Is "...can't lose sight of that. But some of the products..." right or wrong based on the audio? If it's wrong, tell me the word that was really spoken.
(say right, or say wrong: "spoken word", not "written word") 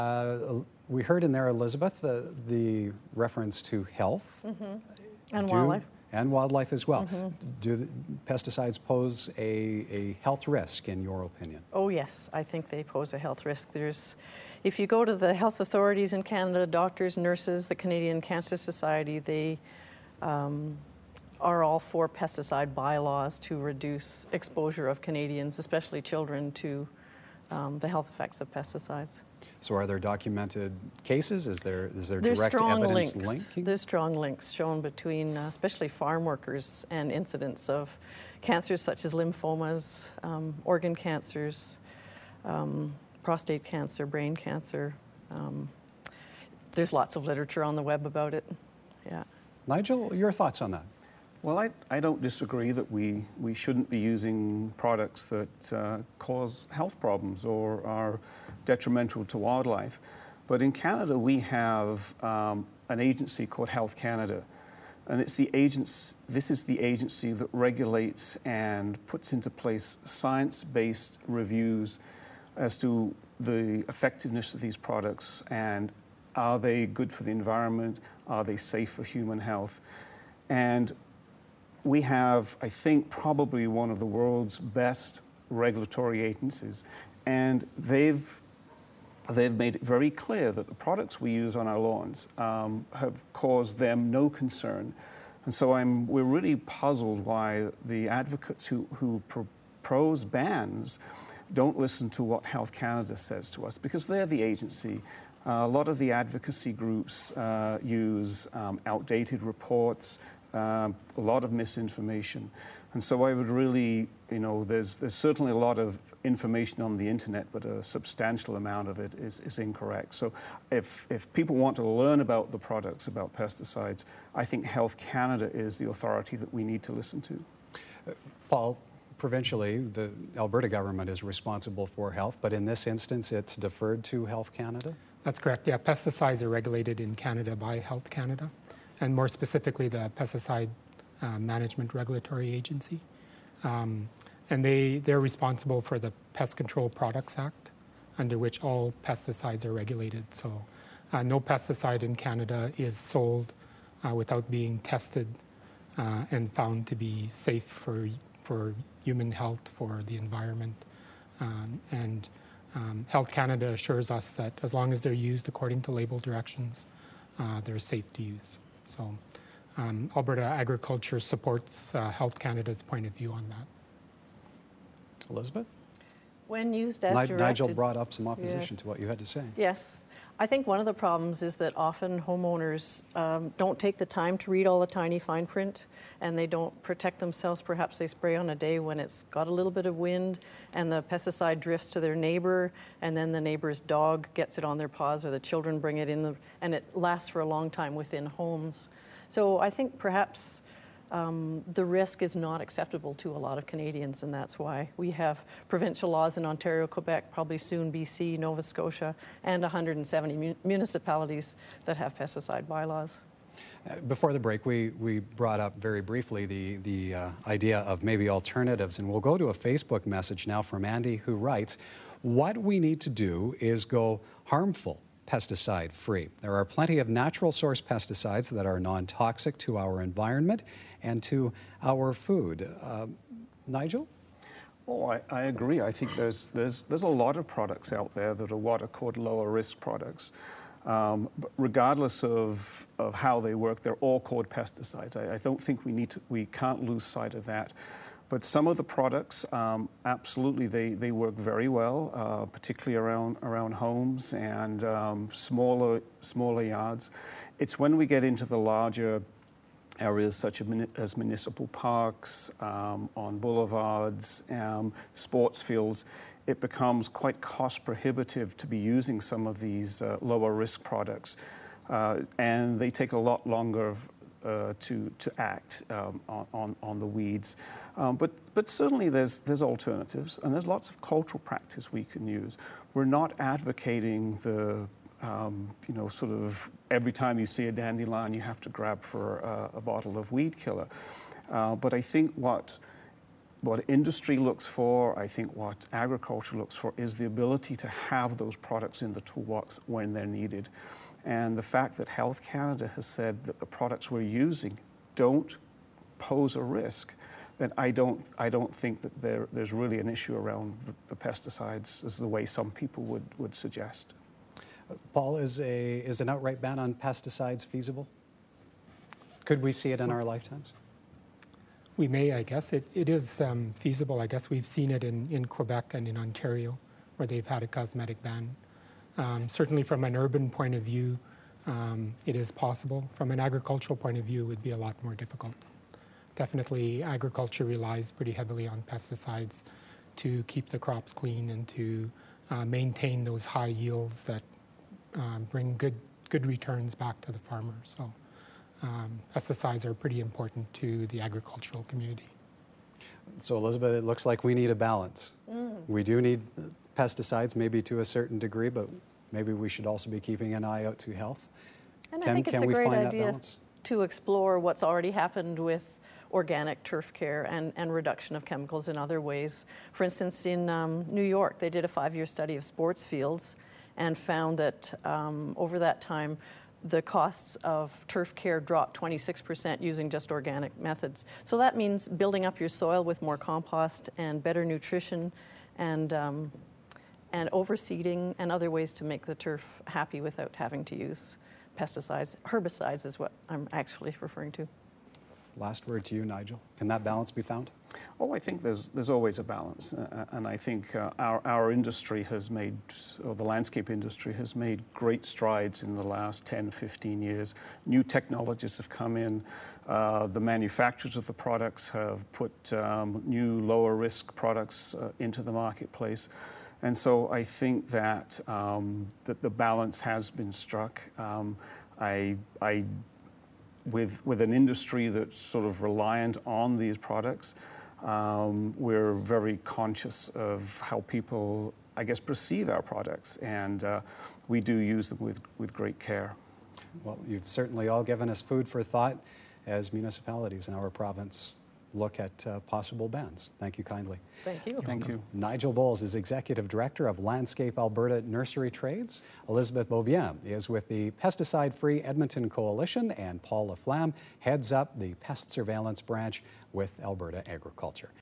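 right.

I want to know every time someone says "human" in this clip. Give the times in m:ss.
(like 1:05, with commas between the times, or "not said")
1:19, 2:39.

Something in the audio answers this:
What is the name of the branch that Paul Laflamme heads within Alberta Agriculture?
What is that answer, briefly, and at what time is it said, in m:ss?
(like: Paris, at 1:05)
Pest Surveillance Branch, at 7:35.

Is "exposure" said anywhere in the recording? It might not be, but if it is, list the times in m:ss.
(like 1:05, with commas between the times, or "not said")
0:24.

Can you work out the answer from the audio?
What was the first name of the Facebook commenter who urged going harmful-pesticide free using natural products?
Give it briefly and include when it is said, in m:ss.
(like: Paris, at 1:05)
Andy, at 3:40.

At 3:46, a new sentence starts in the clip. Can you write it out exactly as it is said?
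There are plenty of natural source pesticides that are non toxic to our environment and to our food.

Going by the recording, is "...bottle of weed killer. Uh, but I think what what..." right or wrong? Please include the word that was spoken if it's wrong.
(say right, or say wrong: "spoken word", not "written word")
right.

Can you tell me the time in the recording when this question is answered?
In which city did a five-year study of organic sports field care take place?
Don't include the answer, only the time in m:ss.
6:11.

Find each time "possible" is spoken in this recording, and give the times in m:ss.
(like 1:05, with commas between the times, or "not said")
5:32, 7:22.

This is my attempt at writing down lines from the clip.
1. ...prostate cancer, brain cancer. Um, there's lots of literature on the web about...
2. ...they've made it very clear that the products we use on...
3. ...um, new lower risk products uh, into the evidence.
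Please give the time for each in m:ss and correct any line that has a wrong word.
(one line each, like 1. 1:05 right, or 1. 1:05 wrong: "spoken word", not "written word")
1. 0:43 right
2. 1:29 right
3. 6:52 wrong: "marketplace", not "evidence".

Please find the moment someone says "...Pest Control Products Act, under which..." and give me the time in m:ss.
2:26.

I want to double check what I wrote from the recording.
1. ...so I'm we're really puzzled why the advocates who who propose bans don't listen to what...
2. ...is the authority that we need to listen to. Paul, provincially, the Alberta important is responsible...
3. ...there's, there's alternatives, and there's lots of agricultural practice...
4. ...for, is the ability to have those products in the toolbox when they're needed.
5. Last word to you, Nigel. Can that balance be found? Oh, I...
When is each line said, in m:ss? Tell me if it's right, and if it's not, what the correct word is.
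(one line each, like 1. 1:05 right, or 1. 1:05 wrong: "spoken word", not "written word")
1. 1:35 right
2. 2:05 wrong: "government", not "important"
3. 4:39 wrong: "cultural", not "agricultural"
4. 4:56 right
5. 6:35 right.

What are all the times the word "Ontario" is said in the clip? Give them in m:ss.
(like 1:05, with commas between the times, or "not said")
3:26, 5:26.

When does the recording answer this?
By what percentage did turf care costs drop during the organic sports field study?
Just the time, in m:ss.
6:18.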